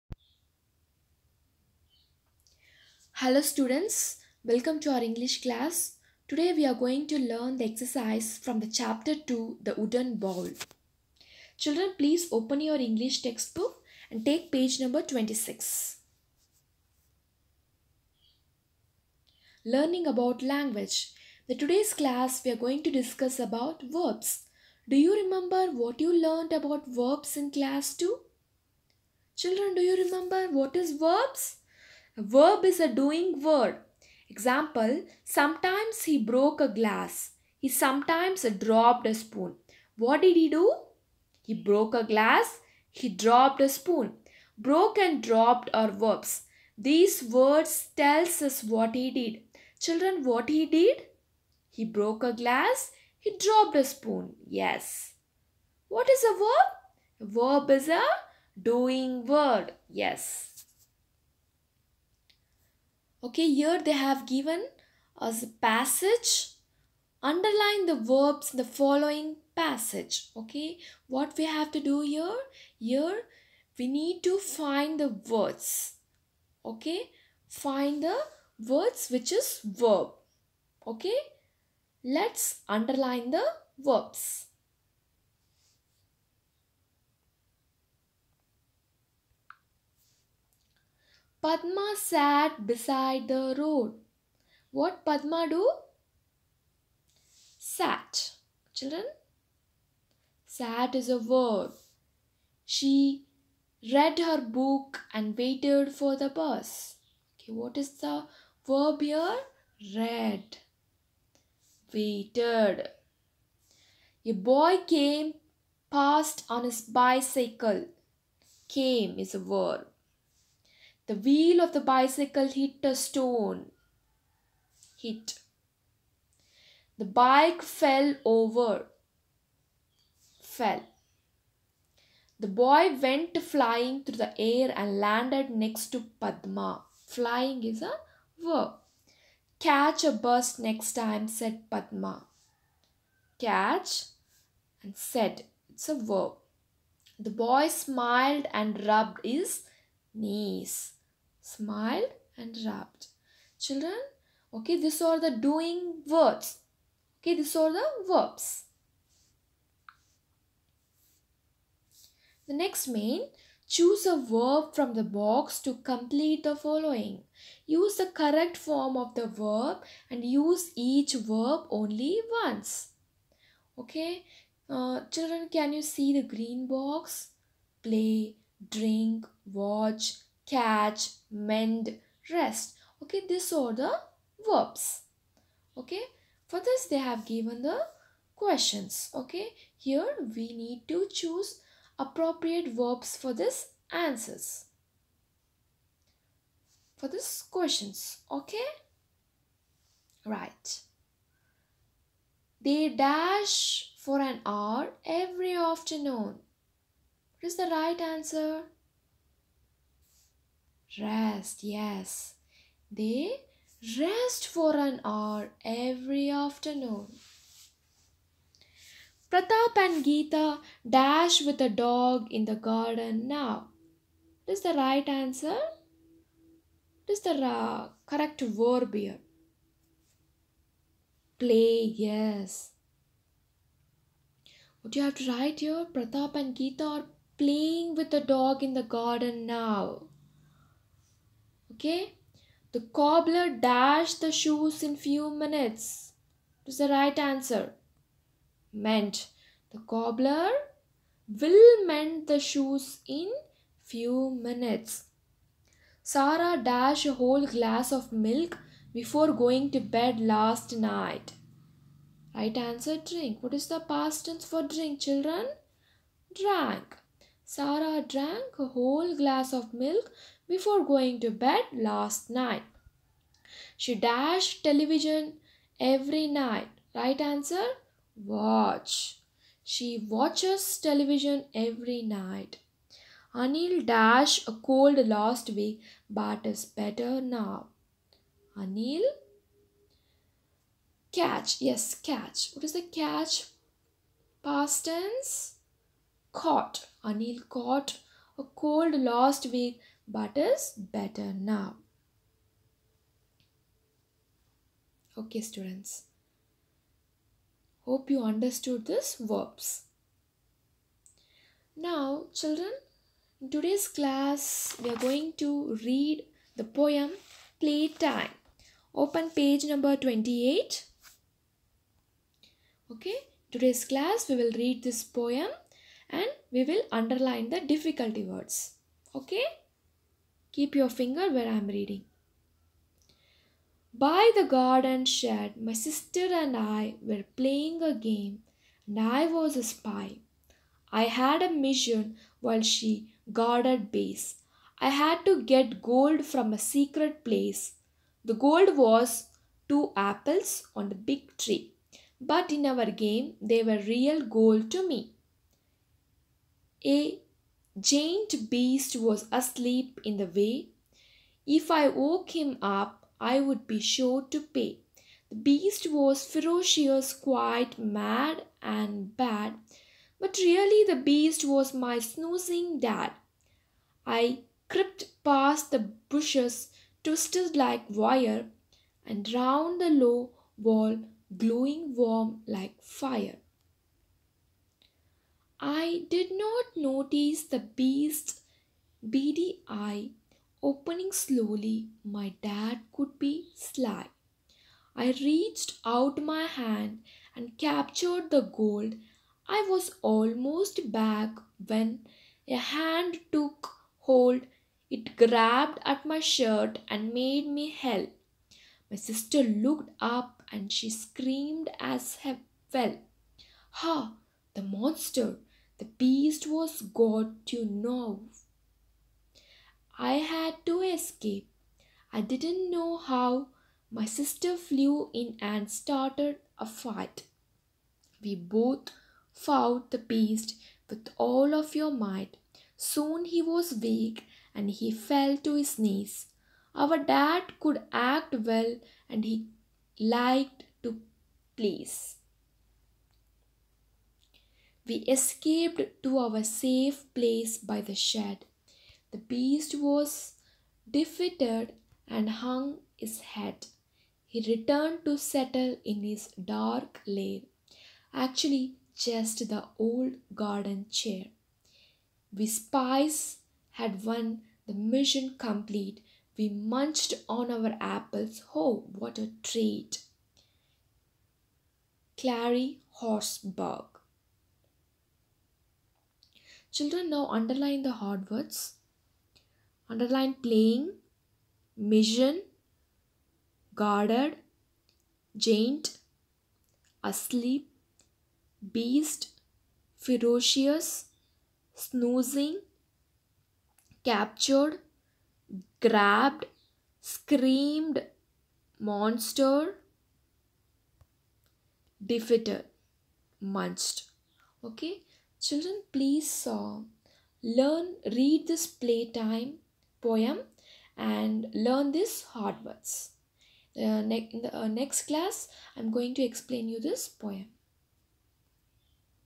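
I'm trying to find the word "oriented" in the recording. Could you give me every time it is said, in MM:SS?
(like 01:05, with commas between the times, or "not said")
not said.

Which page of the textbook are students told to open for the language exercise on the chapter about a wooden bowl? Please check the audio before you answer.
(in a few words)
26.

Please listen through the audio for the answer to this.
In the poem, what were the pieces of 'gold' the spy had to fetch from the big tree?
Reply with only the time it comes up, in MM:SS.
05:49.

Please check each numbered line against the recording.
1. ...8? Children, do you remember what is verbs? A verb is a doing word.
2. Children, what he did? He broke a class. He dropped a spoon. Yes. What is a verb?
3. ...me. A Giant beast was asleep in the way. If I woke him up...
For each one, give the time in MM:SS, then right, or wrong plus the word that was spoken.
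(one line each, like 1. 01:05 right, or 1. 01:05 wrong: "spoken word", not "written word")
1. 00:27 wrong: "2", not "8"
2. 00:49 wrong: "glass", not "class"
3. 05:54 right.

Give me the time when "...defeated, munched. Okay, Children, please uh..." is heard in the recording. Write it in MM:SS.
08:22.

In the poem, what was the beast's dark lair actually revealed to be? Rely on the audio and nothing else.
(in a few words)
old garden chair.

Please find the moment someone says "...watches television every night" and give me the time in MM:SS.
04:40.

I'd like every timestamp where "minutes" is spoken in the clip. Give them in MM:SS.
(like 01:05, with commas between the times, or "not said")
04:05, 04:14.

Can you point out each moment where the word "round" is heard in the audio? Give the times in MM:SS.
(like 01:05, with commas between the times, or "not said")
06:19.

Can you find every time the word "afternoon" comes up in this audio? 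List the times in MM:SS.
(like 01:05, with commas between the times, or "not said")
03:25, 03:36.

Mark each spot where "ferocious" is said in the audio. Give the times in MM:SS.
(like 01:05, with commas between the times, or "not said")
06:06, 08:09.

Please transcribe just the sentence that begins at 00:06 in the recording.
Today we are going to learn the exercise from the chapter 2, The Wooden Bowl.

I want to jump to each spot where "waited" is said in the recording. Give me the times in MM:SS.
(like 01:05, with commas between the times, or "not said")
01:45, 01:51.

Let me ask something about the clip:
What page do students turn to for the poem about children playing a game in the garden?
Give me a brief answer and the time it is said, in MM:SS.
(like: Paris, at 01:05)
28, at 05:19.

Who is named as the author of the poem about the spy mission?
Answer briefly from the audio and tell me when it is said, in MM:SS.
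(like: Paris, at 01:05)
Clary Horsburgh, at 07:52.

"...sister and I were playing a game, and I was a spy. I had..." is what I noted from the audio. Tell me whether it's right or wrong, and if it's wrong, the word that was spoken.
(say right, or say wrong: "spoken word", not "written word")
right.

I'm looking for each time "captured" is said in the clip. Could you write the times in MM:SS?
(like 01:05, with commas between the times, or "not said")
06:37, 08:14.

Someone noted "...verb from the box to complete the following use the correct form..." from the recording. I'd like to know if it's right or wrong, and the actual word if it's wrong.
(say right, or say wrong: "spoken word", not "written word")
right.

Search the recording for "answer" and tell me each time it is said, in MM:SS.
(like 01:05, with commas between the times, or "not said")
03:13, 03:27, 03:45, 04:07, 04:22, 04:37.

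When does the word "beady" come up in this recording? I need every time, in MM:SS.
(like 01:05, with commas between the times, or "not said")
06:29.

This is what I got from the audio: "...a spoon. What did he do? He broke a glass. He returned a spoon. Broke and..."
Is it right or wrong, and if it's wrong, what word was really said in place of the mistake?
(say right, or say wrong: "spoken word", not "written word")
wrong: "dropped", not "returned".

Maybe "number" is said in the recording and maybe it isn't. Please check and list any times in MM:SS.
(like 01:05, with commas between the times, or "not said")
00:14, 05:19.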